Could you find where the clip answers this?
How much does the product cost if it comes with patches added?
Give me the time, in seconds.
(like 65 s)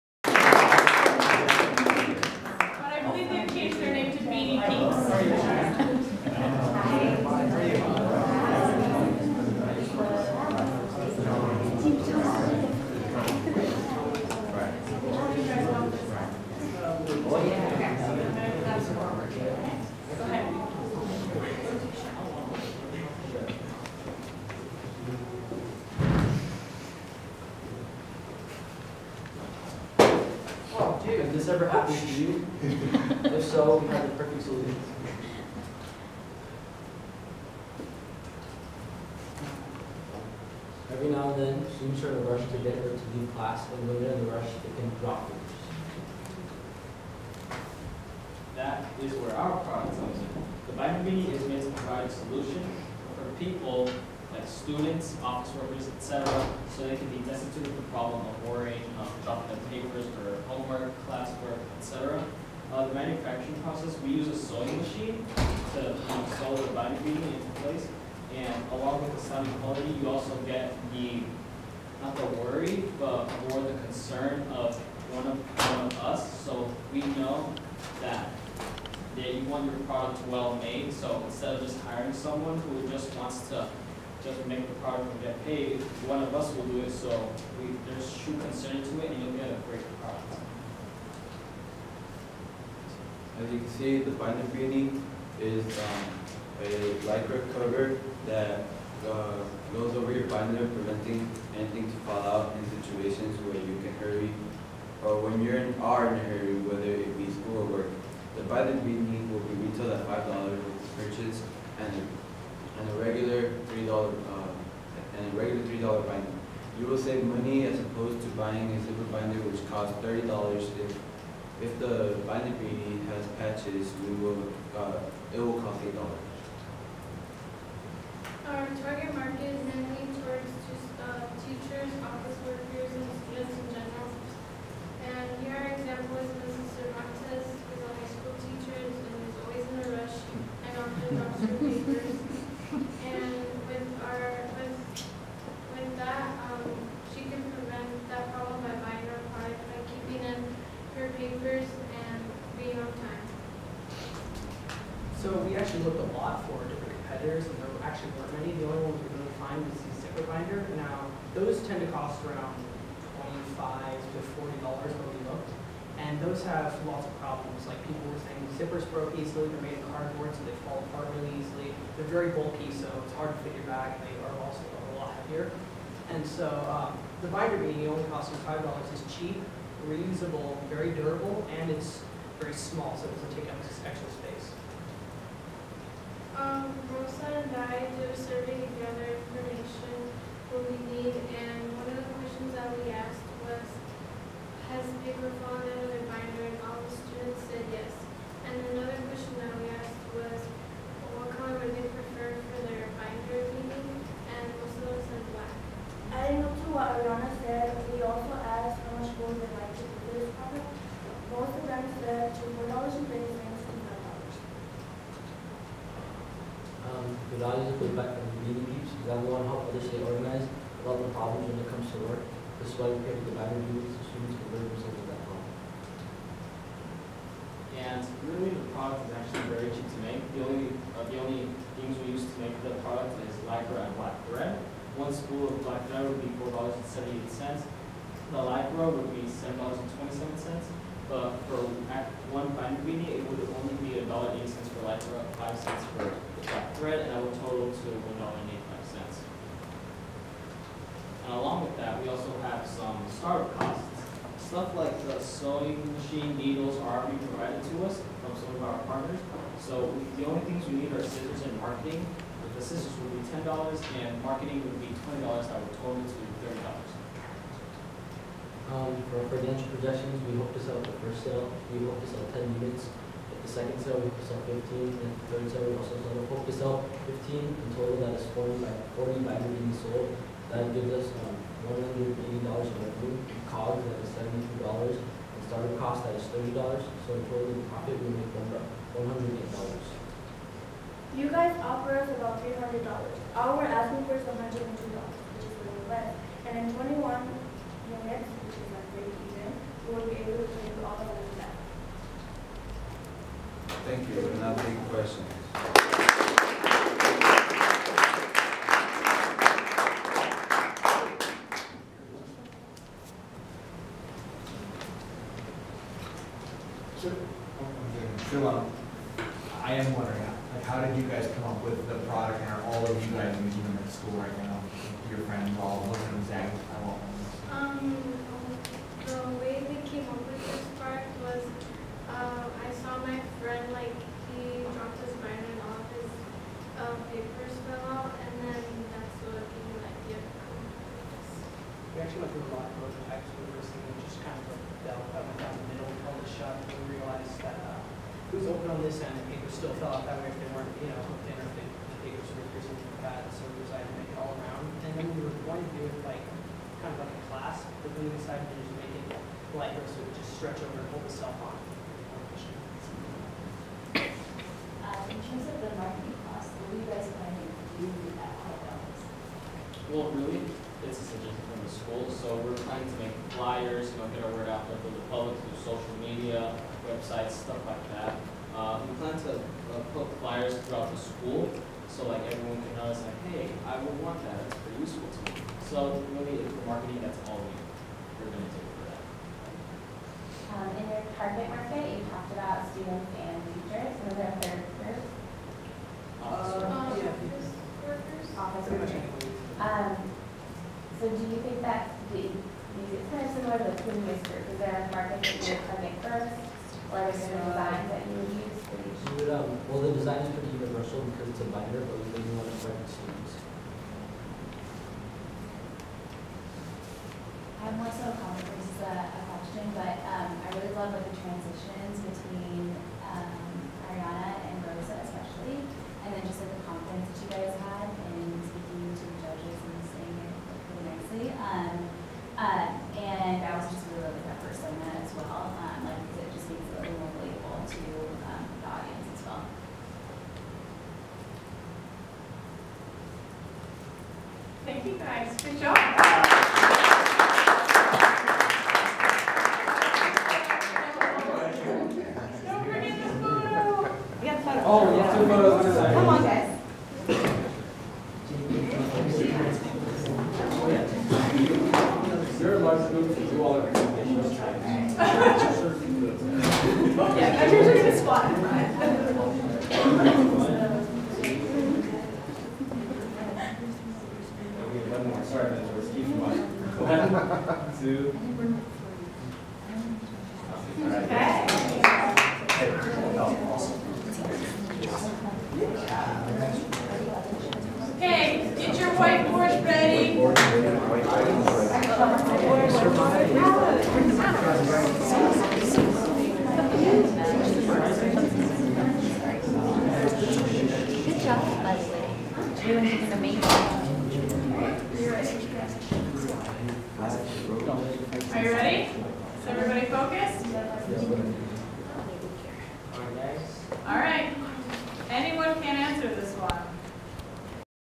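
125 s.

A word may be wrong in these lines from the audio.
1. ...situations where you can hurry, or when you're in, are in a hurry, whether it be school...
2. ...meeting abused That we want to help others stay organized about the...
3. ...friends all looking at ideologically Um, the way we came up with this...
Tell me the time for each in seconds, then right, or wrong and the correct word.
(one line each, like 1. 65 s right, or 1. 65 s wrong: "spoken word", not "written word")
1. 102 s right
2. 218 s right
3. 325 s wrong: "exactly", not "ideologically".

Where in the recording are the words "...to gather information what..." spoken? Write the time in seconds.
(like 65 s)
188 s.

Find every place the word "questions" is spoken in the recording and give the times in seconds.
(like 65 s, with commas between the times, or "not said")
192 s, 304 s, 419 s.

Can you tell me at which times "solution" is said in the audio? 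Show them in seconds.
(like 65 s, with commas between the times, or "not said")
34 s, 52 s.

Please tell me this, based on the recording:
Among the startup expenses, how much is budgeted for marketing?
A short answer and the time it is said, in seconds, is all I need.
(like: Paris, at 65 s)
$20, at 264 s.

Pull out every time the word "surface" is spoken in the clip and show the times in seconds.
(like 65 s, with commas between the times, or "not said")
not said.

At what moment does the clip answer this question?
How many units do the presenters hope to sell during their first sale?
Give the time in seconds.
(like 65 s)
272 s.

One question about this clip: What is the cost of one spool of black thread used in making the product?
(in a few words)
$4.78.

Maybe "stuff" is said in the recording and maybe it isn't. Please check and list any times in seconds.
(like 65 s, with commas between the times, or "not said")
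254 s, 377 s.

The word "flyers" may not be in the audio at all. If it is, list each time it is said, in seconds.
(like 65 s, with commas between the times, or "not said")
373 s, 380 s.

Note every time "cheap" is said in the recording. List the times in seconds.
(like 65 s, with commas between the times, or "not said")
179 s, 229 s.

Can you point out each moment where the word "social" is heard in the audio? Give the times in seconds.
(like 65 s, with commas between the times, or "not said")
375 s.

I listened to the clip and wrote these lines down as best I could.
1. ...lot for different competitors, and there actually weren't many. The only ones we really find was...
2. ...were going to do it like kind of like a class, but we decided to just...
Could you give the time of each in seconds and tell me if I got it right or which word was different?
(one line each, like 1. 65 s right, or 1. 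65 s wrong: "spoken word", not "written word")
1. 156 s right
2. 355 s right.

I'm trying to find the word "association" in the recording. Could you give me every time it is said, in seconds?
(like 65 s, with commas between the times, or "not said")
not said.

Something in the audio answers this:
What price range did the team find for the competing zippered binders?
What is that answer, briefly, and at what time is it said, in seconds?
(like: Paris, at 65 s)
$25 to $40, at 163 s.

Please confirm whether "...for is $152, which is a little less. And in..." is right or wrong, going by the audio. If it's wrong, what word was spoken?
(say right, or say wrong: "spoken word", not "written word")
wrong: "102", not "152".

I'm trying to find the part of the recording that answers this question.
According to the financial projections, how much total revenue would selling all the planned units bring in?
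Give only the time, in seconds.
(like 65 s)
281 s.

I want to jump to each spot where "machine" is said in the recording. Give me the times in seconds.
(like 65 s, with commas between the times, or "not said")
64 s, 255 s.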